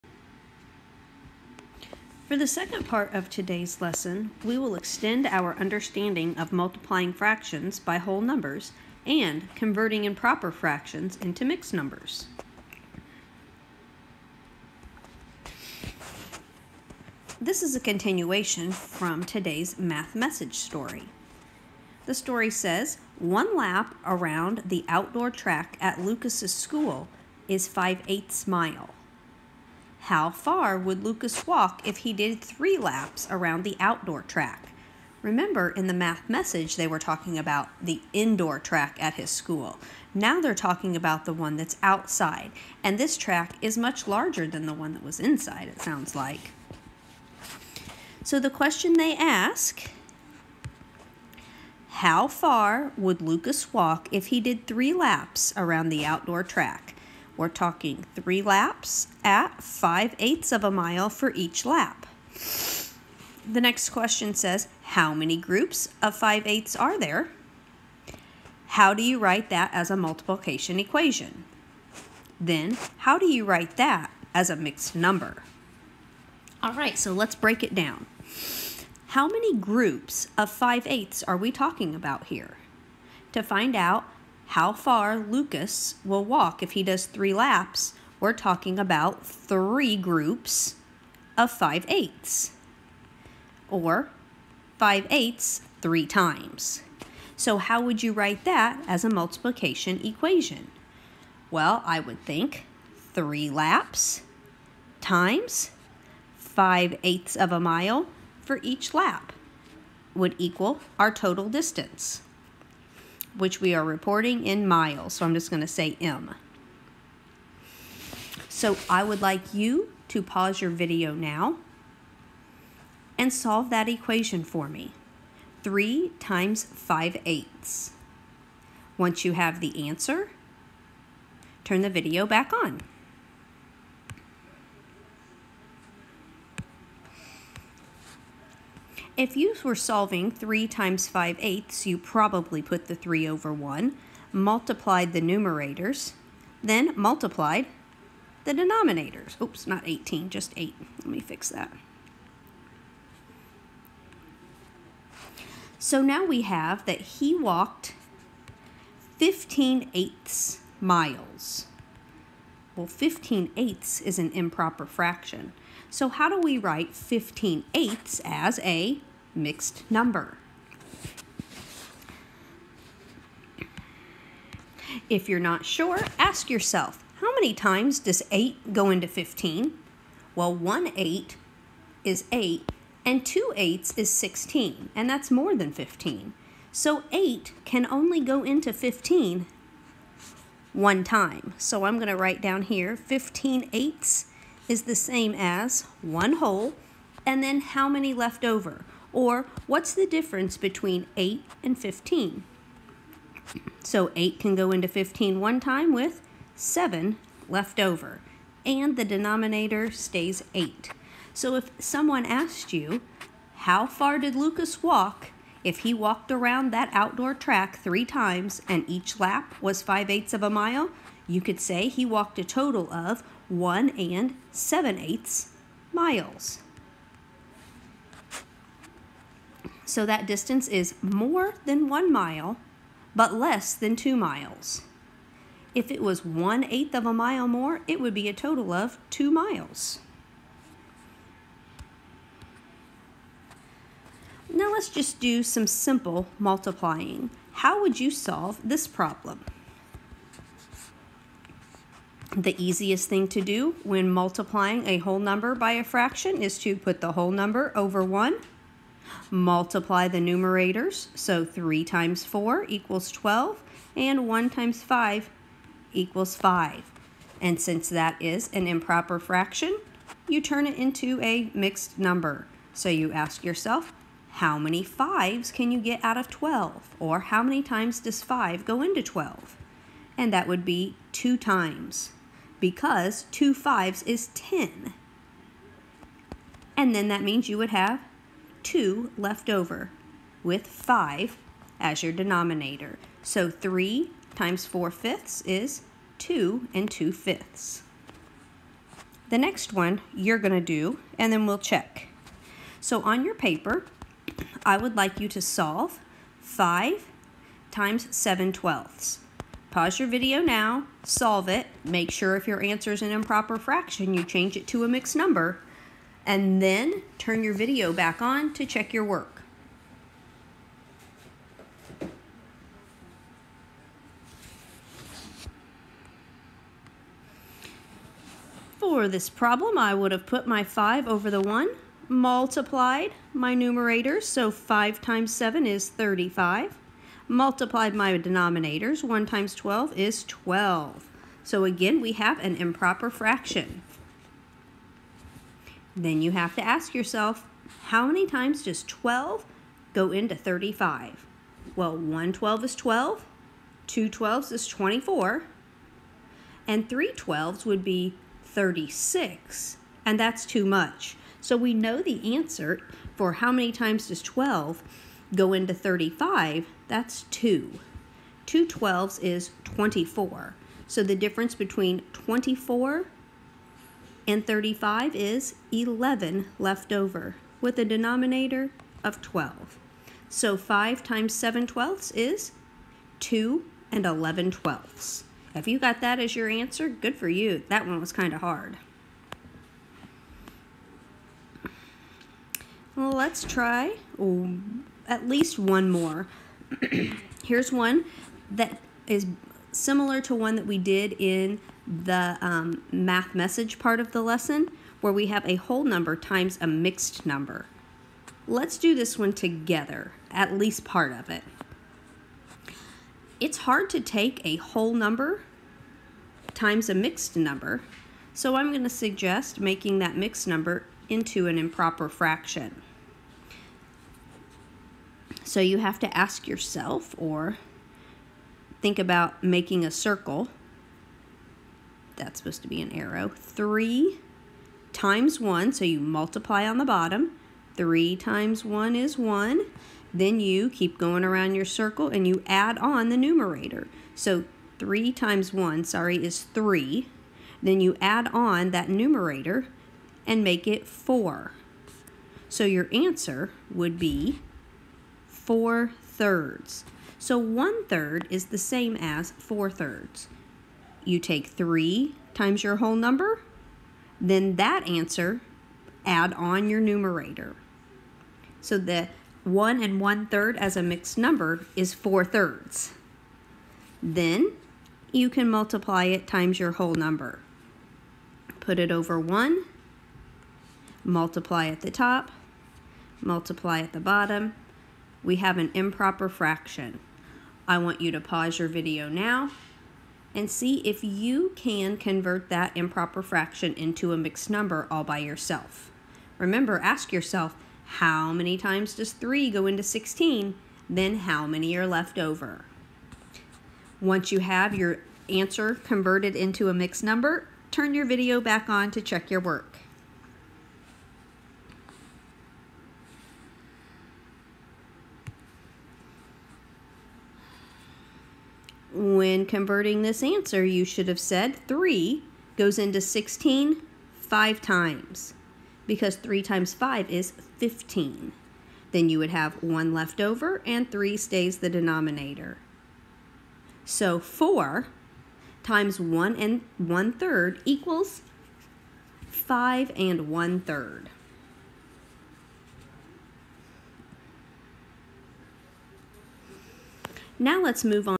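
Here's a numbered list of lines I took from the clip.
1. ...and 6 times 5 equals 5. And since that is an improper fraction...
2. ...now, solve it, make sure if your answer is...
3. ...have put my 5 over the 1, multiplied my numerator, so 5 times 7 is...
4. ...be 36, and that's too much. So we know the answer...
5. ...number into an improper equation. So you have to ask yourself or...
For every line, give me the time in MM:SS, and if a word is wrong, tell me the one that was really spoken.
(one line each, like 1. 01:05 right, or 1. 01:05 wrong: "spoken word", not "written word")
1. 04:23 wrong: "1", not "6"
2. 05:10 right
3. 05:30 right
4. 05:57 right
5. 07:00 wrong: "fraction", not "equation".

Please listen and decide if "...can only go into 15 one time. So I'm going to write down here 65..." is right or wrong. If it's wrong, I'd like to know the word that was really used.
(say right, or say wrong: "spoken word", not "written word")
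wrong: "15", not "65".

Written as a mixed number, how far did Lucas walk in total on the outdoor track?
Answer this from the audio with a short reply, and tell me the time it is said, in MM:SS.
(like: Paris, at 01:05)
1 and 7/8 miles, at 03:43.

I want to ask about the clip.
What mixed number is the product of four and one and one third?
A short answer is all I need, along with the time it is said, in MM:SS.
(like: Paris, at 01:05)
5 and 1/3, at 08:59.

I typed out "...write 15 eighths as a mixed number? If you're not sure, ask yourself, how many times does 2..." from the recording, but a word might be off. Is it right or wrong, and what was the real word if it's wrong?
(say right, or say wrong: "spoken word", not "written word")
wrong: "8", not "2".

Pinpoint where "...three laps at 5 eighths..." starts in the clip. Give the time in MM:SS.
00:58.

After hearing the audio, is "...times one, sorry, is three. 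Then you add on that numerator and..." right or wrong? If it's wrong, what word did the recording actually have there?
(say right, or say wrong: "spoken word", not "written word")
right.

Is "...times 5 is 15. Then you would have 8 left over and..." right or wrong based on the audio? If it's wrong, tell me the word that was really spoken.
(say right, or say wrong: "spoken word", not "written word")
wrong: "1", not "8".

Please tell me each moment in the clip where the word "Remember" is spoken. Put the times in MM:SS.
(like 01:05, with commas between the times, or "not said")
00:35, 08:16.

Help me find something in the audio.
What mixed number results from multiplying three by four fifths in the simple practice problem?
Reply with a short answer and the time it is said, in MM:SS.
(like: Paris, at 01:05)
2 and 2/5, at 04:56.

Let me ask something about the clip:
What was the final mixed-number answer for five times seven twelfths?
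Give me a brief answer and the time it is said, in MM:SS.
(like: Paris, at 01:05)
2 and 11/12, at 06:23.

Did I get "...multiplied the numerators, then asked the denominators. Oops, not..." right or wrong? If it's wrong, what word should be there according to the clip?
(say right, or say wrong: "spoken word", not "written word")
wrong: "multiplied", not "asked".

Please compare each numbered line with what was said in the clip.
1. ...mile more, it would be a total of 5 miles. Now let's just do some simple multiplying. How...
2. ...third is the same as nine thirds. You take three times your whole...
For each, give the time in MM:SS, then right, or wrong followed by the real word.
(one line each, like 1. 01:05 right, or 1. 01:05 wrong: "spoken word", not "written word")
1. 03:57 wrong: "2", not "5"
2. 07:37 wrong: "four", not "nine".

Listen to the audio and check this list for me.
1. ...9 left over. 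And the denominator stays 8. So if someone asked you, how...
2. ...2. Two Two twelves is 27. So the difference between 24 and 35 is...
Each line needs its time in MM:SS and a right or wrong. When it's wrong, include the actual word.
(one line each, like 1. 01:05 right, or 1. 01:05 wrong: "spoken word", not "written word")
1. 03:26 wrong: "7", not "9"
2. 06:07 wrong: "24", not "27".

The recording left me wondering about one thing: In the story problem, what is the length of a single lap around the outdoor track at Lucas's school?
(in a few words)
5/8 mile.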